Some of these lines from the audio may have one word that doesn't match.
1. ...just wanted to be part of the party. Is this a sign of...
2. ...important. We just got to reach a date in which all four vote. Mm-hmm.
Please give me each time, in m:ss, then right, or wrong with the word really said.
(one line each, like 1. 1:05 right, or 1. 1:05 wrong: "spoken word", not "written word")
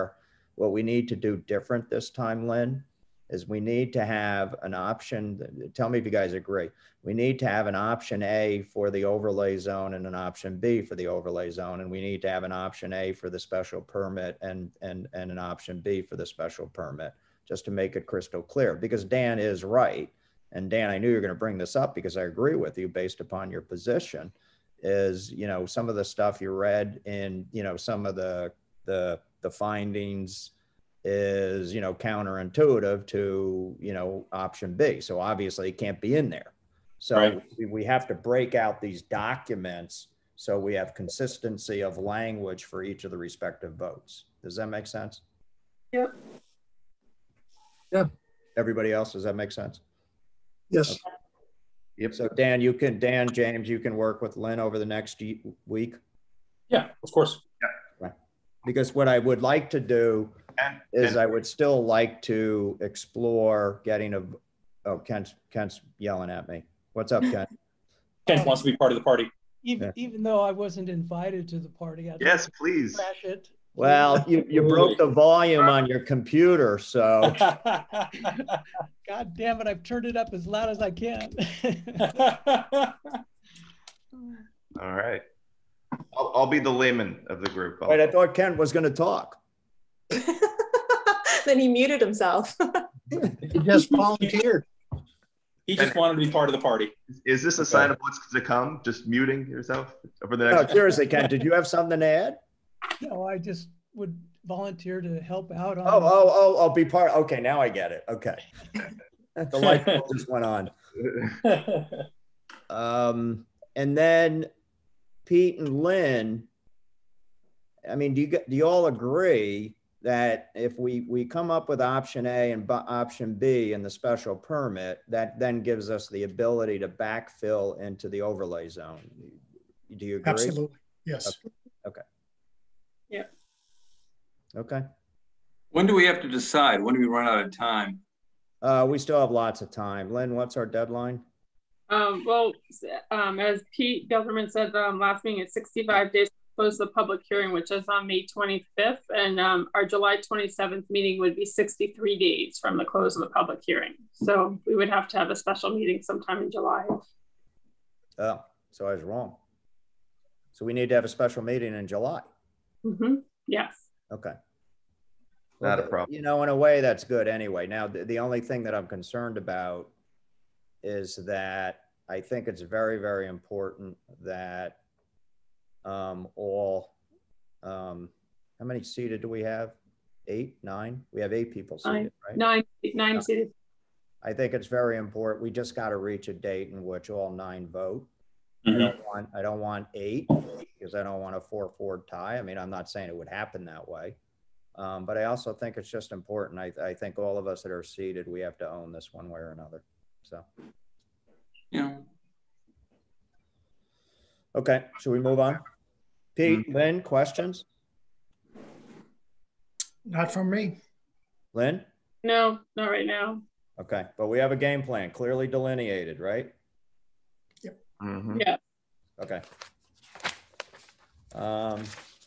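1. 1:35 right
2. 3:04 wrong: "nine", not "four".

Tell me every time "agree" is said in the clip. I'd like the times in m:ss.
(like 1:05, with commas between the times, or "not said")
0:06, 0:22, 1:58, 2:10.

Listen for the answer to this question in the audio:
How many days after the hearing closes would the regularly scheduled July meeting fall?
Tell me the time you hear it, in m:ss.
2:31.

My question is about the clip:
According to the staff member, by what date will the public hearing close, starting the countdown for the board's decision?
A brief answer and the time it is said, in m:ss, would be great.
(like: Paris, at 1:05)
May 25th, at 2:28.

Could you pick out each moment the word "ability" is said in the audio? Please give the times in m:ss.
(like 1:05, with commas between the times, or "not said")
2:06.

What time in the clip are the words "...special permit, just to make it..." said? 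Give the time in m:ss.
0:16.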